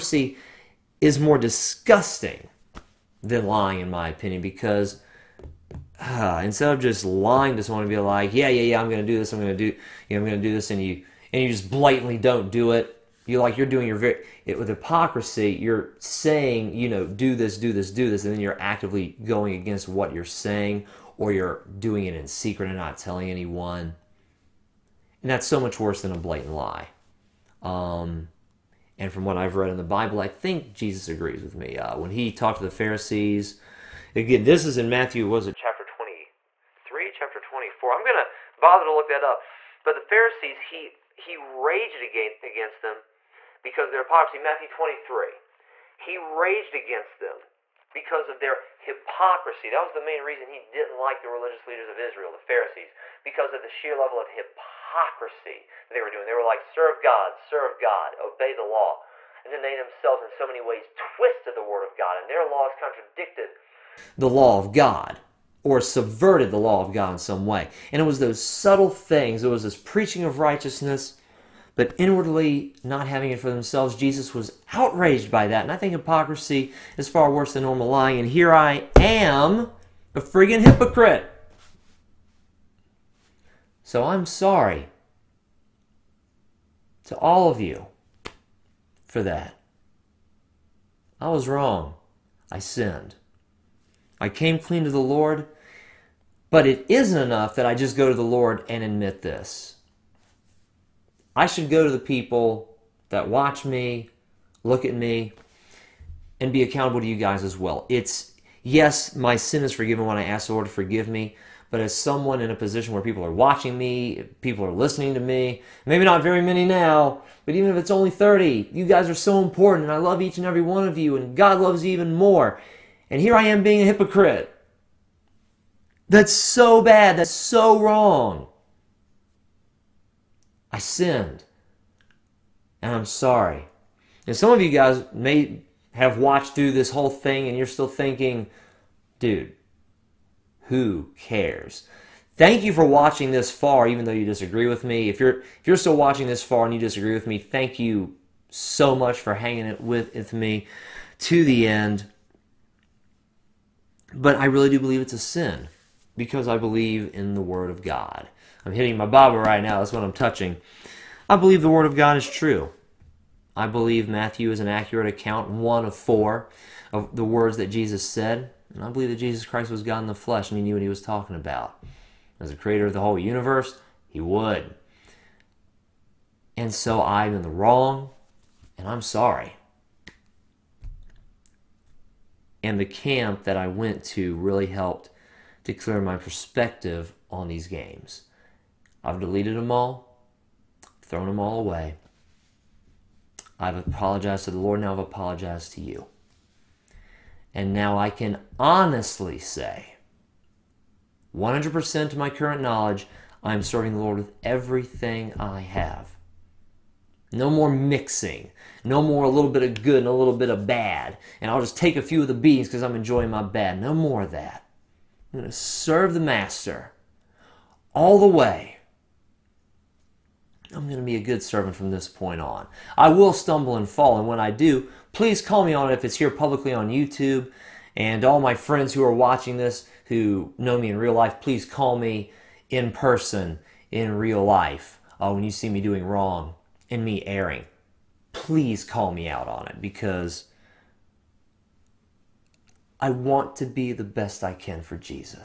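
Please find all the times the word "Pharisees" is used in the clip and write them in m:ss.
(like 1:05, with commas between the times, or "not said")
0:32, 0:40, 0:52.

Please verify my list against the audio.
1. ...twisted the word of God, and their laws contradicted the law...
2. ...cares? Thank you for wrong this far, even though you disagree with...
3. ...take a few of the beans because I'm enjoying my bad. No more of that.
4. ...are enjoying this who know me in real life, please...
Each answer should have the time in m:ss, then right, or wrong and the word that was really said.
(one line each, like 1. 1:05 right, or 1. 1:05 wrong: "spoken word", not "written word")
1. 1:00 right
2. 2:21 wrong: "watching", not "wrong"
3. 3:31 right
4. 3:49 wrong: "watching", not "enjoying".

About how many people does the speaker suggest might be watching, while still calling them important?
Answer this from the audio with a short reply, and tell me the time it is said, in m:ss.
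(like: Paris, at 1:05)
30, at 1:58.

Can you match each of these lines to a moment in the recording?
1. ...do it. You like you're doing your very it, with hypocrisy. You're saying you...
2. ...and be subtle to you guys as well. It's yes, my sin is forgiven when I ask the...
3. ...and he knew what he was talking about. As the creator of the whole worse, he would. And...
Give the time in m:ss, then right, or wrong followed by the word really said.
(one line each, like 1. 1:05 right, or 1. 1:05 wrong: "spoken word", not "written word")
1. 0:12 right
2. 1:46 wrong: "accountable", not "subtle"
3. 2:50 wrong: "universe", not "worse".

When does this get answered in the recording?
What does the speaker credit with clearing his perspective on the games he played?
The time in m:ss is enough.
3:02.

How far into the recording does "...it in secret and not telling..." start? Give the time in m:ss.
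0:22.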